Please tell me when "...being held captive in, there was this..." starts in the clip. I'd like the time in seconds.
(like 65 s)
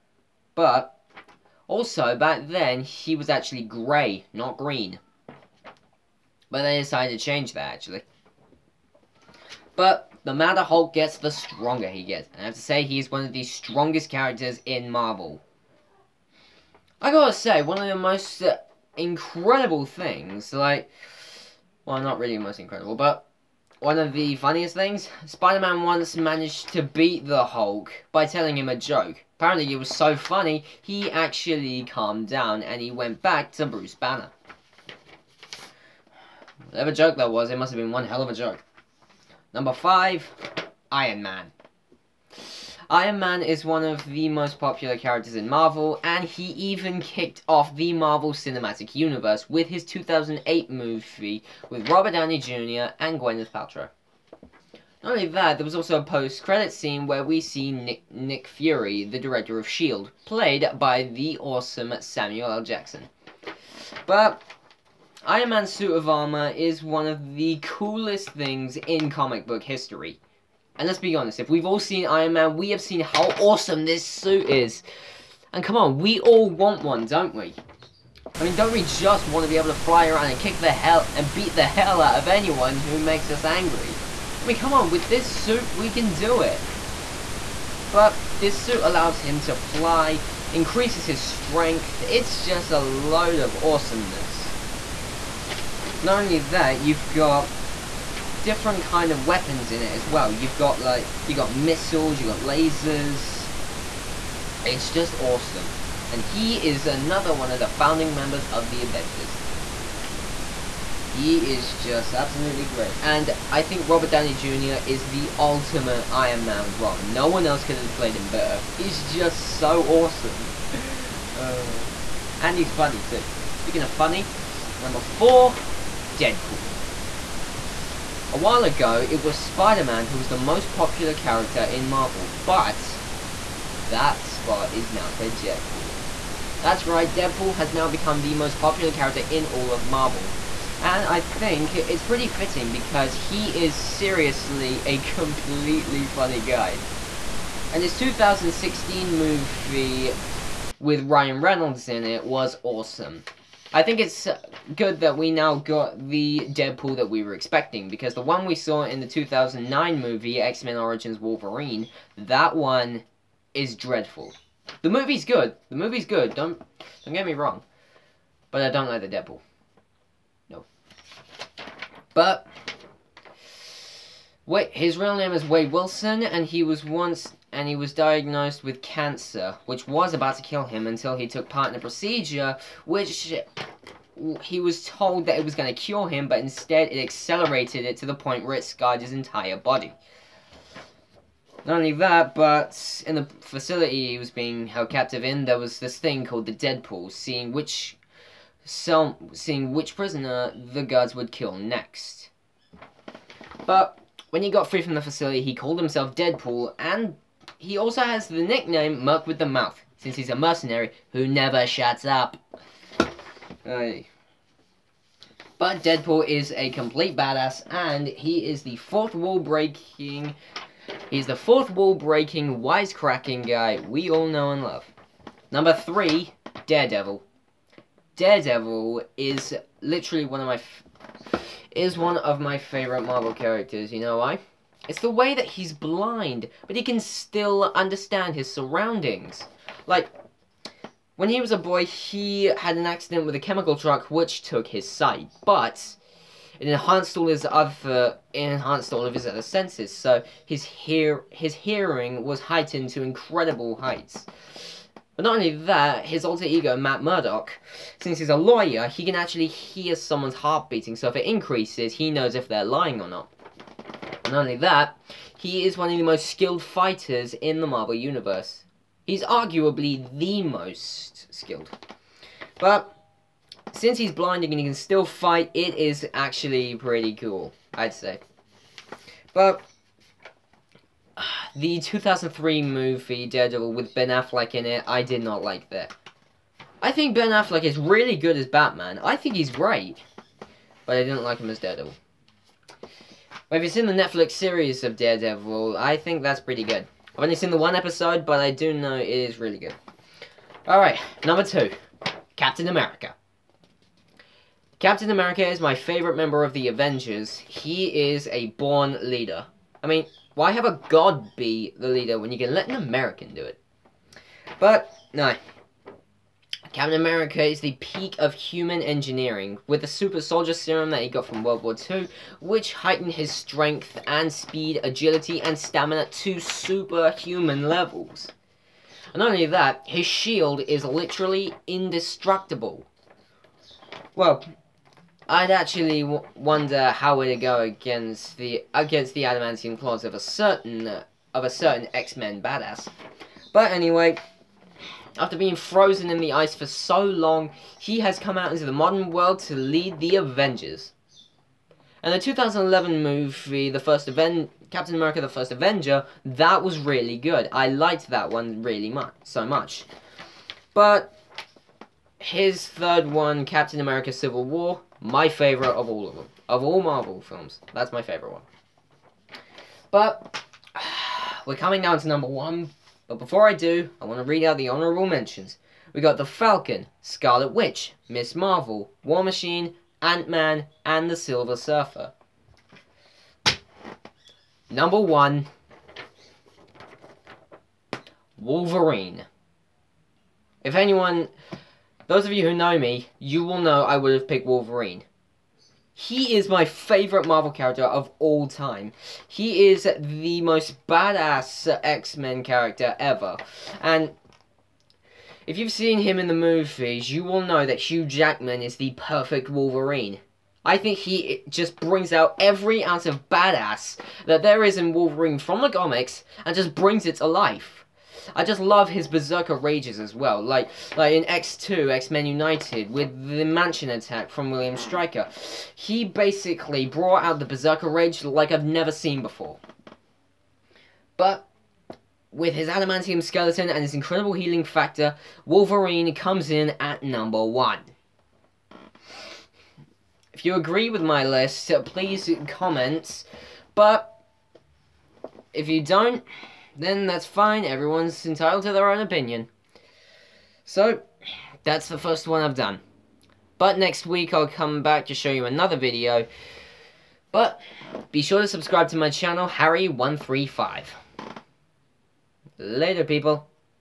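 194 s.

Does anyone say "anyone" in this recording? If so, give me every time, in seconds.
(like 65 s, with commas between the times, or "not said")
82 s, 390 s.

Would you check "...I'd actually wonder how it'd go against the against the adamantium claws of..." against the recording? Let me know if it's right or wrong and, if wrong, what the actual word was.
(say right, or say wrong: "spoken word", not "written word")
right.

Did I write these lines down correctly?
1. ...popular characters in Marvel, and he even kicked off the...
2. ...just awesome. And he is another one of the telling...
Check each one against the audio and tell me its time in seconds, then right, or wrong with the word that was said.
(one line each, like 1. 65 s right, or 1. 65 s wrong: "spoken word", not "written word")
1. 44 s right
2. 104 s wrong: "founding", not "telling".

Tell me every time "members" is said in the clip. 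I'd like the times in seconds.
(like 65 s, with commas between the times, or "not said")
108 s, 306 s.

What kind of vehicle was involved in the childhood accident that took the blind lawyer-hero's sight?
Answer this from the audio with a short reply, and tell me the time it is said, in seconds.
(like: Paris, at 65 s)
chemical truck, at 243 s.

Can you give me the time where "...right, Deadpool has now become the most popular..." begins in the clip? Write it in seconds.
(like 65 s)
136 s.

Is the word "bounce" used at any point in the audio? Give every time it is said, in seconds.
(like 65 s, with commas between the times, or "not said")
not said.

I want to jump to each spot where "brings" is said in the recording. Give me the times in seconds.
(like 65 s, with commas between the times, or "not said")
411 s, 416 s.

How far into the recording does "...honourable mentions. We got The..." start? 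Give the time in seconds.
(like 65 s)
374 s.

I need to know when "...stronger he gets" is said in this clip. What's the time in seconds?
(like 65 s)
11 s.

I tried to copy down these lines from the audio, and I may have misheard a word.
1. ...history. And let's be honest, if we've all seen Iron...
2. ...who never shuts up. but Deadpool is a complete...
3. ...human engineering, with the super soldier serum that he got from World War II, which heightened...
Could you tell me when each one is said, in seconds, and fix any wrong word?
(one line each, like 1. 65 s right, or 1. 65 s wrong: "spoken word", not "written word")
1. 69 s right
2. 211 s right
3. 318 s right.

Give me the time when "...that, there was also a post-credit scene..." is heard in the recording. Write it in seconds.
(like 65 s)
55 s.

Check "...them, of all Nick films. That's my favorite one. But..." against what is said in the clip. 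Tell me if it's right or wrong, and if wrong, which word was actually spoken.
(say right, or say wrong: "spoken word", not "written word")
wrong: "Marvel", not "Nick".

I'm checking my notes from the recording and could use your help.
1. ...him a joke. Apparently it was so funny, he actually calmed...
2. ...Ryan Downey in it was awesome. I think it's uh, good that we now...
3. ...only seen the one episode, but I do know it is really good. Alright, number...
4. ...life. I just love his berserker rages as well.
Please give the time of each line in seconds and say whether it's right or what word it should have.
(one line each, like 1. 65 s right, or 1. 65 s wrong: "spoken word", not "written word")
1. 28 s right
2. 151 s wrong: "Reynolds", not "Downey"
3. 297 s right
4. 417 s right.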